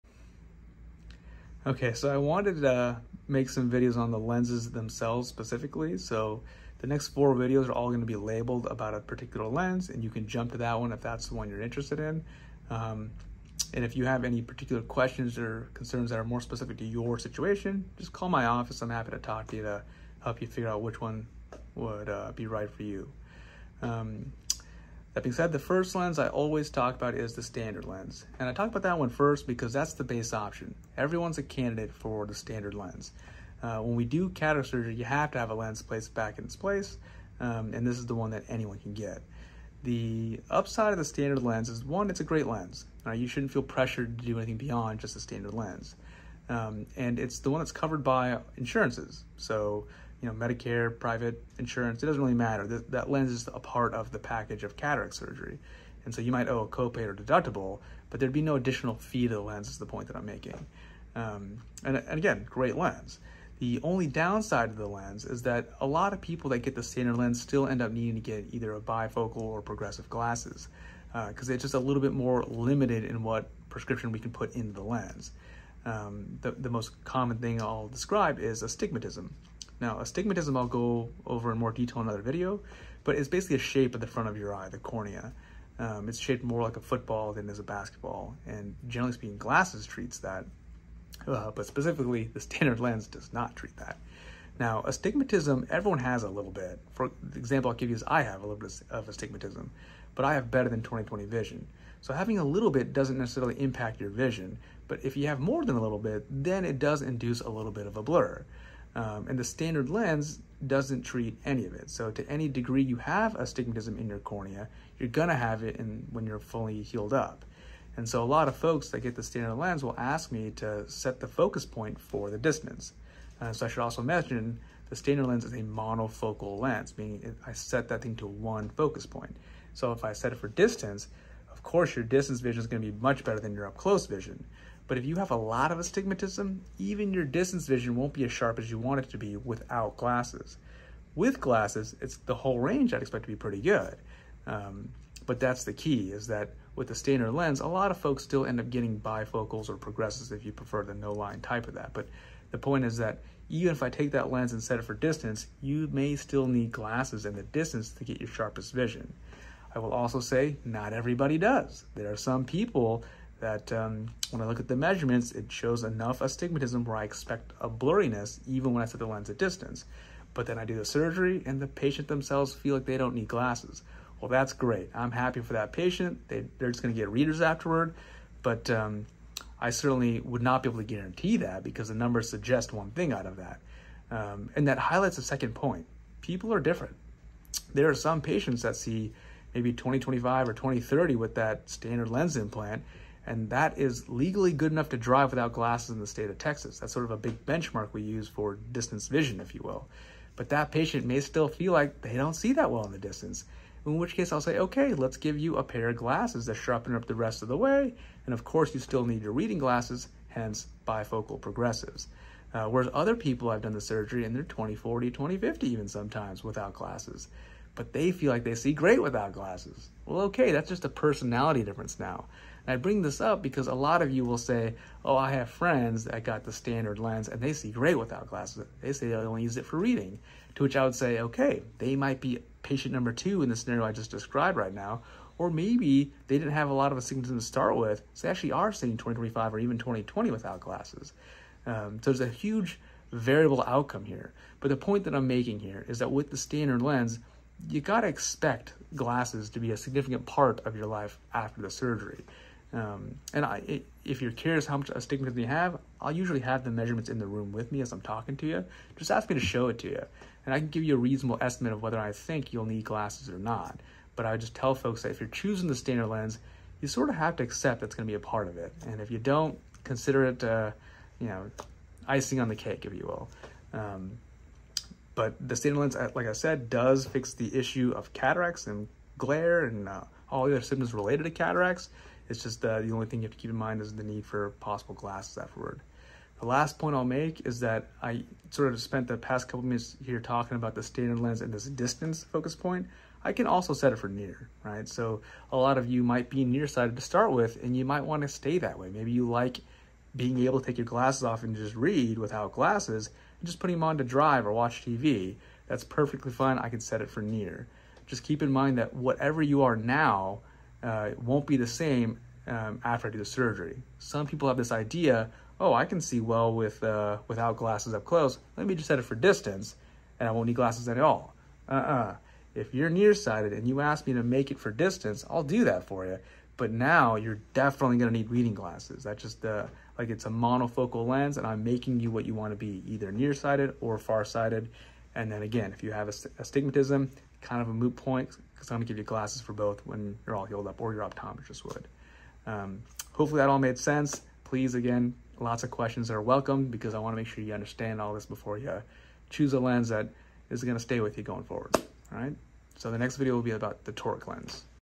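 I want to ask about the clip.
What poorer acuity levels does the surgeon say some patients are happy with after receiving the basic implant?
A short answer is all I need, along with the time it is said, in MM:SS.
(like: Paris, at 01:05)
20/40, 20/50, at 03:34.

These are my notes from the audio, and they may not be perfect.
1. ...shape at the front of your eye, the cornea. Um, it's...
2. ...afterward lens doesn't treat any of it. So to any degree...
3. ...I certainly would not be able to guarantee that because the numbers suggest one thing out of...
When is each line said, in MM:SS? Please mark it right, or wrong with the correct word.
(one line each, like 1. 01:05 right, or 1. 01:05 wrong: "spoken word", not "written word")
1. 01:23 right
2. 01:49 wrong: "standard", not "afterward"
3. 02:59 right.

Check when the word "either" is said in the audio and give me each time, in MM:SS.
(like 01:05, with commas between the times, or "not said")
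01:08, 05:32.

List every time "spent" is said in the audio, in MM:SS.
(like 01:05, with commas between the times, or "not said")
04:48.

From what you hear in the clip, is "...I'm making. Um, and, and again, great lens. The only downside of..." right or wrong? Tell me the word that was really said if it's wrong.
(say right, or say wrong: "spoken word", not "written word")
right.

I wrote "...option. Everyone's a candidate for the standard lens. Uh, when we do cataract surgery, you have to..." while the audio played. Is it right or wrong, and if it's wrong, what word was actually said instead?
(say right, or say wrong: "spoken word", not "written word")
right.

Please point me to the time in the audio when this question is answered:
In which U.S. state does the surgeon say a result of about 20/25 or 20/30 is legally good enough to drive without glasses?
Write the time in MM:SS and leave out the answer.
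03:16.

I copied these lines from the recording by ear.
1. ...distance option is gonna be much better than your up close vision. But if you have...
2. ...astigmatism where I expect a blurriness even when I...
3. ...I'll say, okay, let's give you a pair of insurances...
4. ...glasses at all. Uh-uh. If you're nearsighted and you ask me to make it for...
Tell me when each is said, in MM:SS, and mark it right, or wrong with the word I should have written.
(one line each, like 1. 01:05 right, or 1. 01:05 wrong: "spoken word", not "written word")
1. 02:12 wrong: "vision", not "option"
2. 02:46 right
3. 03:24 wrong: "glasses", not "insurances"
4. 05:20 right.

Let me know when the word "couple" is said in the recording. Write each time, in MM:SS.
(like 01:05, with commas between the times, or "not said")
04:49.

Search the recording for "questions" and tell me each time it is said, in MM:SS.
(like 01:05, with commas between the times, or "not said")
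00:14, 05:45.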